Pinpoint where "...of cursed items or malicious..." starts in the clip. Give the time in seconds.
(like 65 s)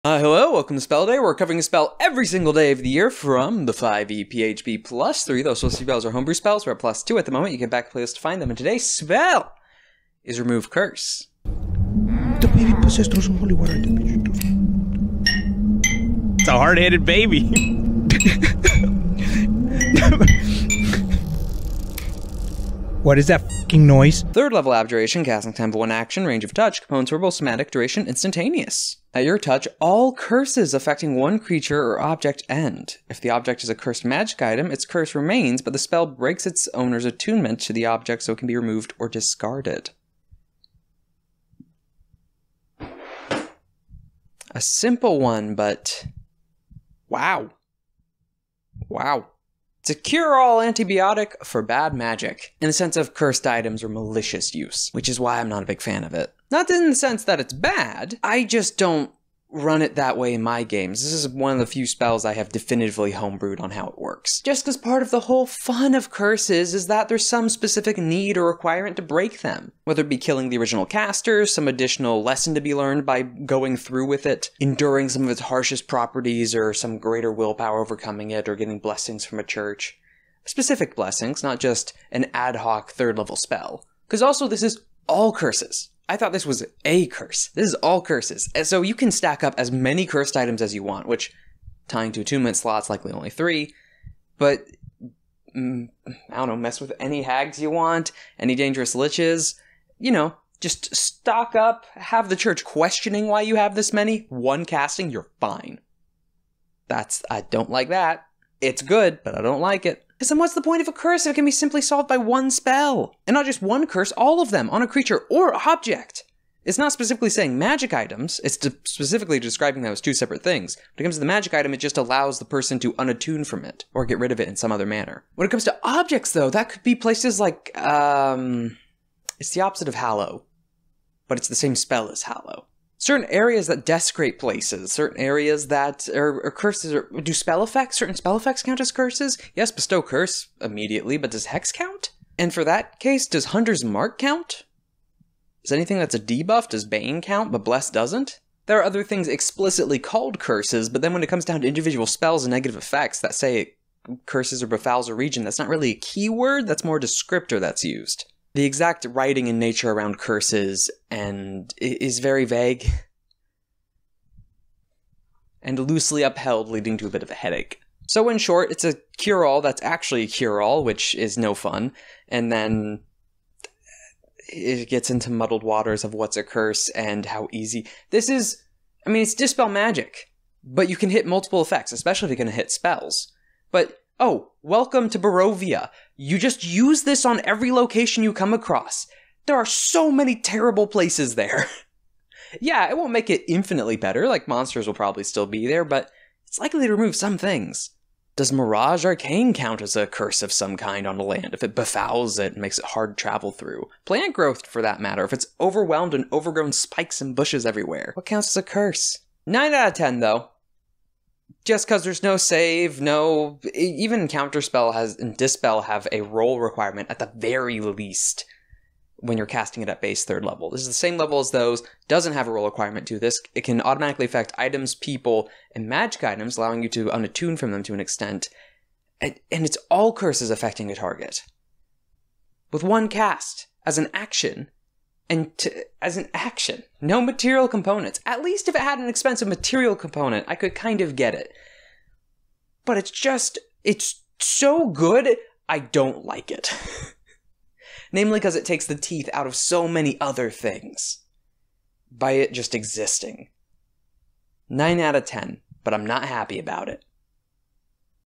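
52 s.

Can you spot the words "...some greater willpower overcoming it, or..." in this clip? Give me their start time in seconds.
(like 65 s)
76 s.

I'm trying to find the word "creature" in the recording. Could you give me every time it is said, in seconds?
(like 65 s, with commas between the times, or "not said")
31 s, 114 s.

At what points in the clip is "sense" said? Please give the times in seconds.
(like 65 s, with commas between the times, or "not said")
52 s, 56 s.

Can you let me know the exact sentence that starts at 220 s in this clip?
This is the same level as those, doesn't have a roll requirement to this.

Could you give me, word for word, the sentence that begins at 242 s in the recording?
But it's just, it's so good, I don't like it.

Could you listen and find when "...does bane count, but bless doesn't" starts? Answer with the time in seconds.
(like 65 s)
146 s.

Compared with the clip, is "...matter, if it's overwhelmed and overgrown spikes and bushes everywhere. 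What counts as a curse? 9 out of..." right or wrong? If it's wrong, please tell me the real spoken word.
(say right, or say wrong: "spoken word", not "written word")
right.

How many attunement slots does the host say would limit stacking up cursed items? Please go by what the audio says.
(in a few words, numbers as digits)
3.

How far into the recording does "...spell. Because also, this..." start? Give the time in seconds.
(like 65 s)
83 s.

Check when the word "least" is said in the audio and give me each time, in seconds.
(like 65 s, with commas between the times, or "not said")
217 s, 238 s.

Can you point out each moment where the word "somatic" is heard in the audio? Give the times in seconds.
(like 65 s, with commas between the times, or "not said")
27 s.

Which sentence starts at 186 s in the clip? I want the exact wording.
You just use this on every location you come across.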